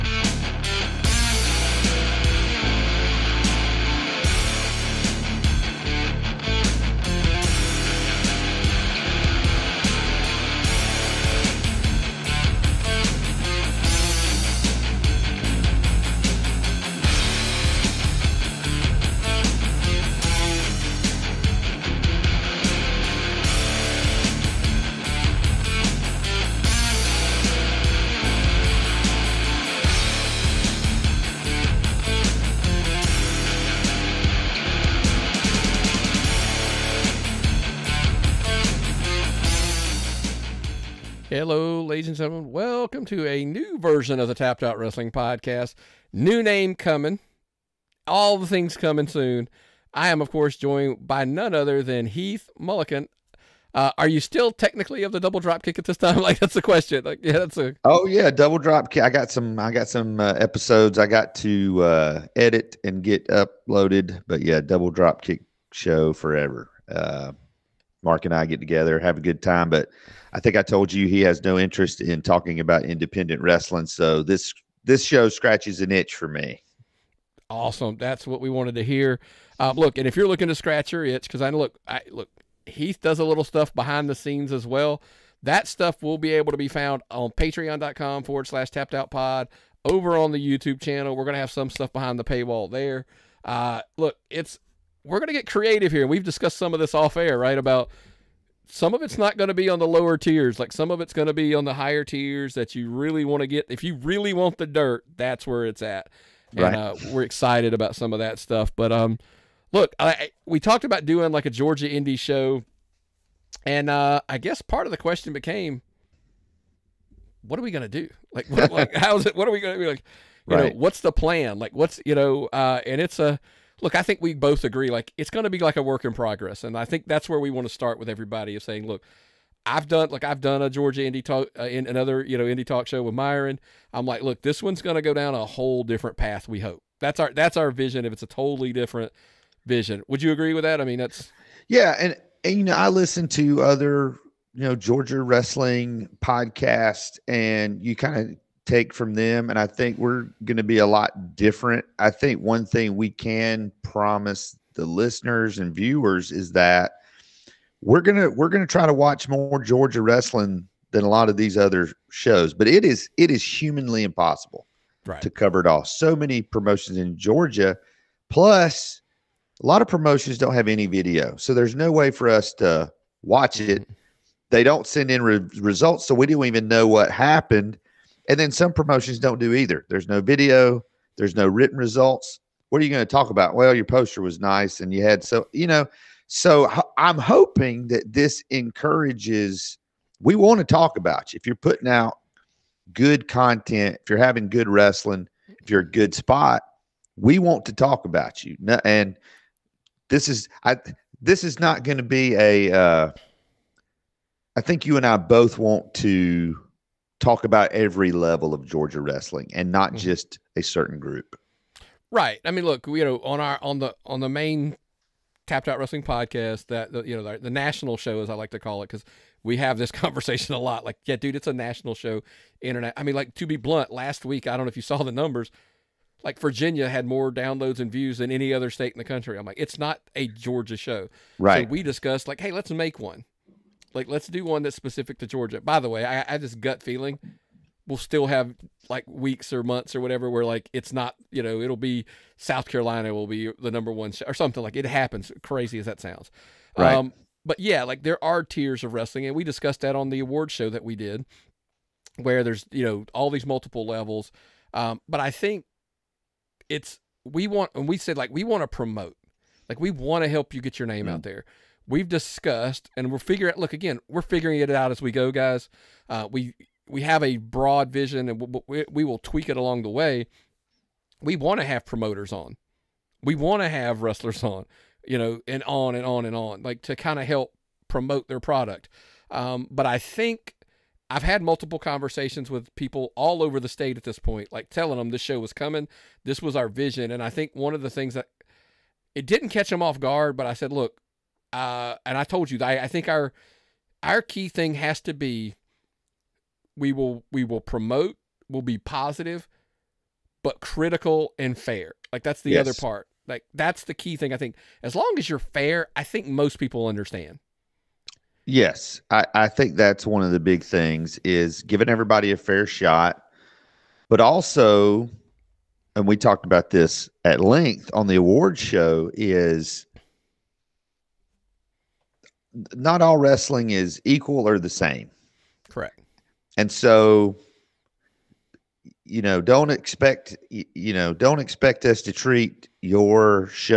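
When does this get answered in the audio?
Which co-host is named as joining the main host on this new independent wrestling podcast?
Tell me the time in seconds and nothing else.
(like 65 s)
52 s.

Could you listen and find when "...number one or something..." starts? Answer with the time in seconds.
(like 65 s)
243 s.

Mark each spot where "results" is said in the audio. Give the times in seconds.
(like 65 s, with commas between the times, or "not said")
175 s, 181 s.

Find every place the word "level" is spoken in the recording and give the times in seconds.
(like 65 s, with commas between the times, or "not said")
208 s, 253 s.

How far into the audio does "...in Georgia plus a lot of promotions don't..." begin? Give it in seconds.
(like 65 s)
166 s.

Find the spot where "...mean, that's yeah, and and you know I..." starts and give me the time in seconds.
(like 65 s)
140 s.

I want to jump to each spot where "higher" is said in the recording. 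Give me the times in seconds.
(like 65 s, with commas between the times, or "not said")
101 s.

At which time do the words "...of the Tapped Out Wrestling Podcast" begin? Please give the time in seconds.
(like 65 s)
44 s.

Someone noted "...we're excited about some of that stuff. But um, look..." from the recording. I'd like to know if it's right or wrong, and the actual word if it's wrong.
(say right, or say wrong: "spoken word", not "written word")
right.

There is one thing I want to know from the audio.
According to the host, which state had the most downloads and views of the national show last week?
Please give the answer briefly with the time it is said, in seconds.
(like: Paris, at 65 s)
Virginia, at 226 s.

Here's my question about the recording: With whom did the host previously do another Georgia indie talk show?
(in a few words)
Myron.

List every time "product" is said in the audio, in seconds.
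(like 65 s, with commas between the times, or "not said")
278 s.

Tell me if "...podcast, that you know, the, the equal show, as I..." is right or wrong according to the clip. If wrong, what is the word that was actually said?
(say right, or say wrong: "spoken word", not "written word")
wrong: "national", not "equal".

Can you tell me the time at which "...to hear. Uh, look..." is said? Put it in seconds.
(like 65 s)
78 s.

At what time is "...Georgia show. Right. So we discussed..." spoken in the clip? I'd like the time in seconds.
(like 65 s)
230 s.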